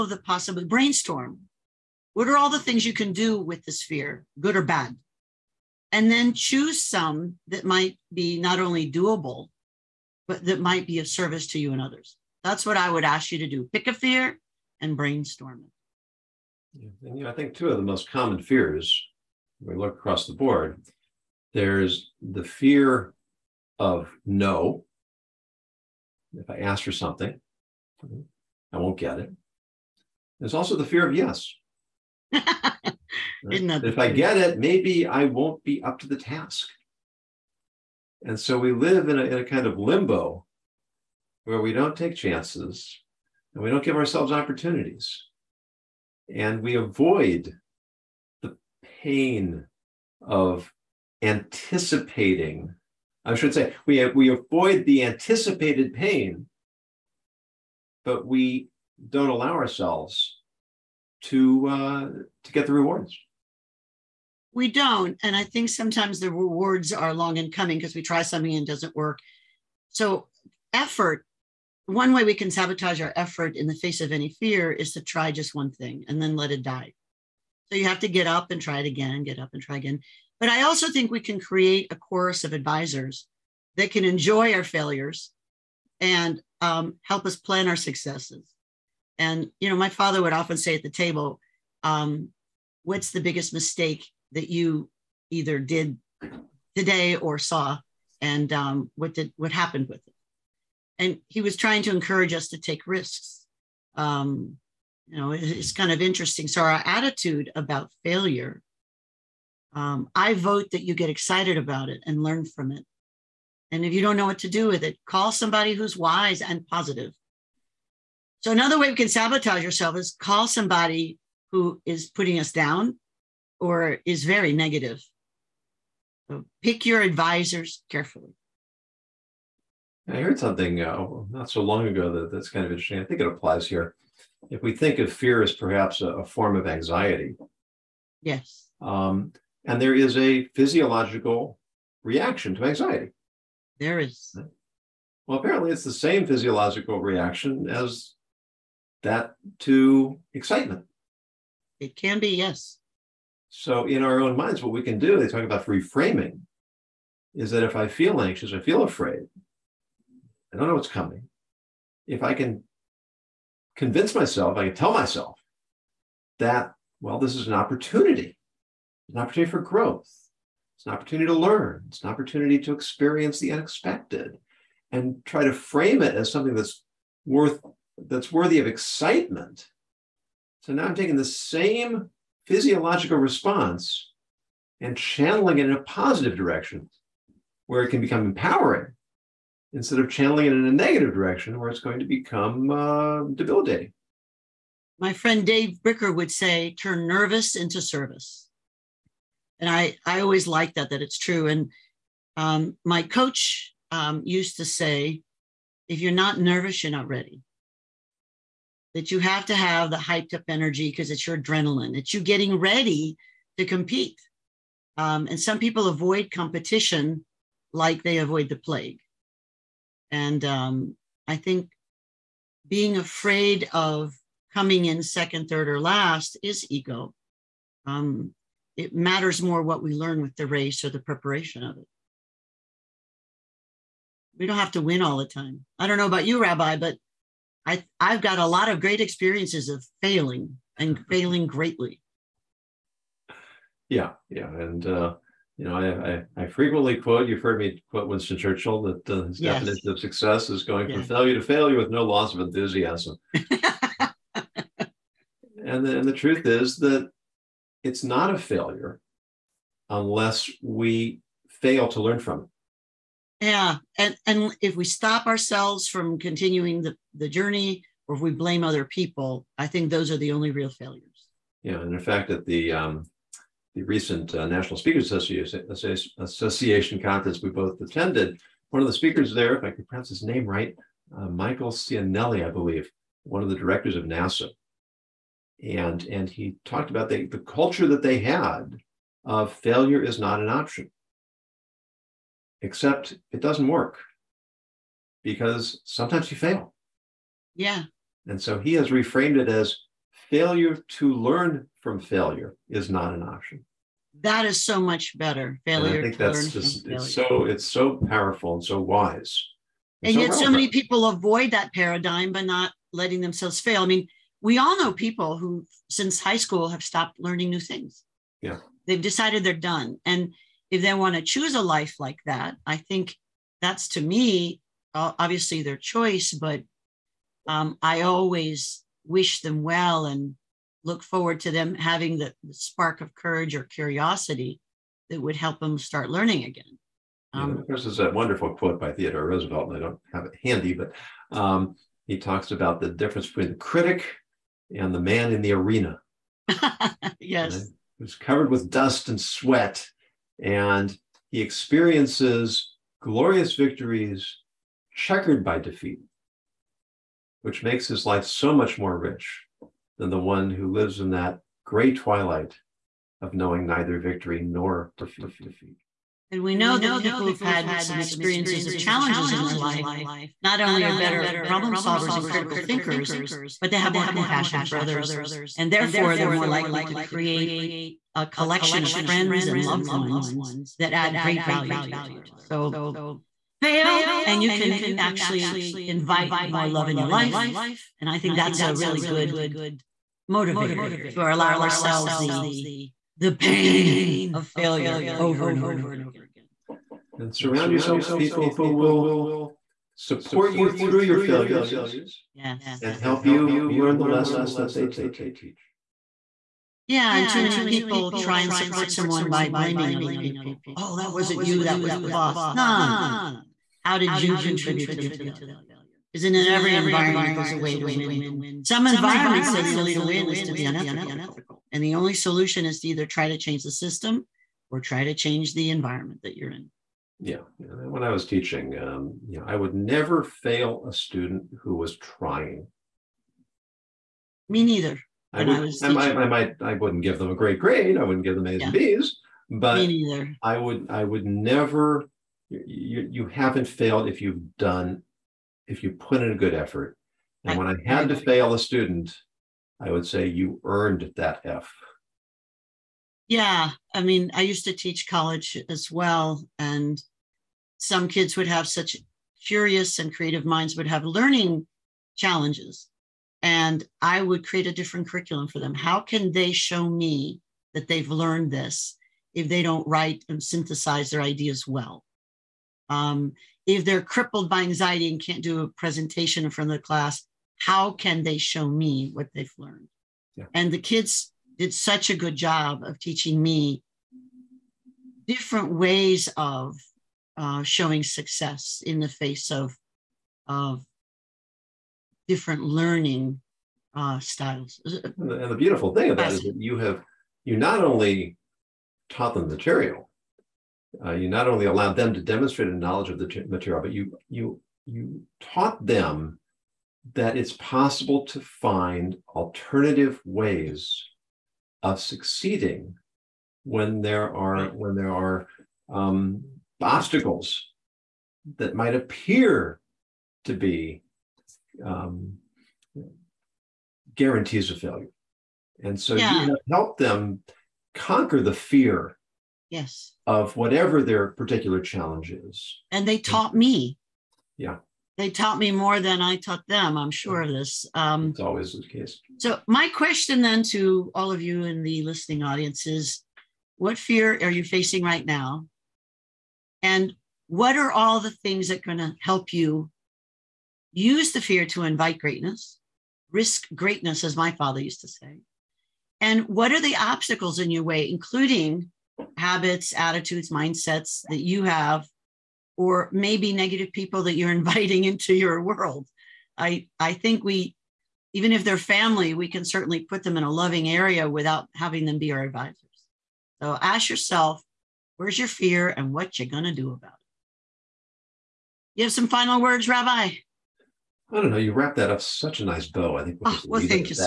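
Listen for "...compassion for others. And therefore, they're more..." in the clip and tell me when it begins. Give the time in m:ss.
6:14.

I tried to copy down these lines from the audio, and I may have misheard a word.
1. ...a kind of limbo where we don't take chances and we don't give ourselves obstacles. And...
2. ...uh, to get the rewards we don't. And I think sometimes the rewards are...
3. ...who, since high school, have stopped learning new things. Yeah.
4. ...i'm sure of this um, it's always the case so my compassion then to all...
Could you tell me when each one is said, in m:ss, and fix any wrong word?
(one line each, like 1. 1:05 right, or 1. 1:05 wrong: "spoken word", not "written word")
1. 0:39 wrong: "opportunities", not "obstacles"
2. 1:01 right
3. 5:15 right
4. 8:56 wrong: "question", not "compassion".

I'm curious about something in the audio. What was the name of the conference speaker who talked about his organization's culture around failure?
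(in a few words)
Michael Cianelli.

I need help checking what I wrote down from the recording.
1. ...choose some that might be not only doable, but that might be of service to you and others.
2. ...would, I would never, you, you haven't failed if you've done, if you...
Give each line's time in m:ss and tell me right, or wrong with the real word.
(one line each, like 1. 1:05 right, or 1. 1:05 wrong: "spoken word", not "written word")
1. 0:06 right
2. 7:20 right.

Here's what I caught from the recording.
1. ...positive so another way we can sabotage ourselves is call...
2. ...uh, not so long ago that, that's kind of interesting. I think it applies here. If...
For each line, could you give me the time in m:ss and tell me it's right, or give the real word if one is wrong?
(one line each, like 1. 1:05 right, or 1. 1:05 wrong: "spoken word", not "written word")
1. 1:56 right
2. 2:10 right.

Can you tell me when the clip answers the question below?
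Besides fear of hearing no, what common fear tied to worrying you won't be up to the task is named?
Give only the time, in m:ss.
0:30.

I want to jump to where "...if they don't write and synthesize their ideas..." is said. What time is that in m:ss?
7:49.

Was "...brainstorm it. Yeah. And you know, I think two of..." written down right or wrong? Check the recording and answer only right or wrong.
right.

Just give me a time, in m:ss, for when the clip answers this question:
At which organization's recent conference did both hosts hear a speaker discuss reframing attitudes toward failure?
4:34.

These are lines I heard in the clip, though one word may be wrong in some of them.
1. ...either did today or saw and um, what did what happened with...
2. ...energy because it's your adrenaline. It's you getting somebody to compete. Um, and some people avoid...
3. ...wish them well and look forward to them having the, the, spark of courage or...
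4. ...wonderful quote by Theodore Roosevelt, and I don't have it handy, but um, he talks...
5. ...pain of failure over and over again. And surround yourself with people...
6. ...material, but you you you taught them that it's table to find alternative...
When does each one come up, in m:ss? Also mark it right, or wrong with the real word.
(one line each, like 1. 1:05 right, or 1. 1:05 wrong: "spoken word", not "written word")
1. 1:35 right
2. 3:30 wrong: "ready", not "somebody"
3. 5:29 right
4. 5:38 right
5. 6:33 right
6. 8:23 wrong: "possible", not "table".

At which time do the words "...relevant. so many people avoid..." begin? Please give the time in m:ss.
5:10.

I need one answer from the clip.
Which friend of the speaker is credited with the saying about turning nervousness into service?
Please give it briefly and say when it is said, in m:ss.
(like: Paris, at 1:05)
Dave Bricker, at 3:15.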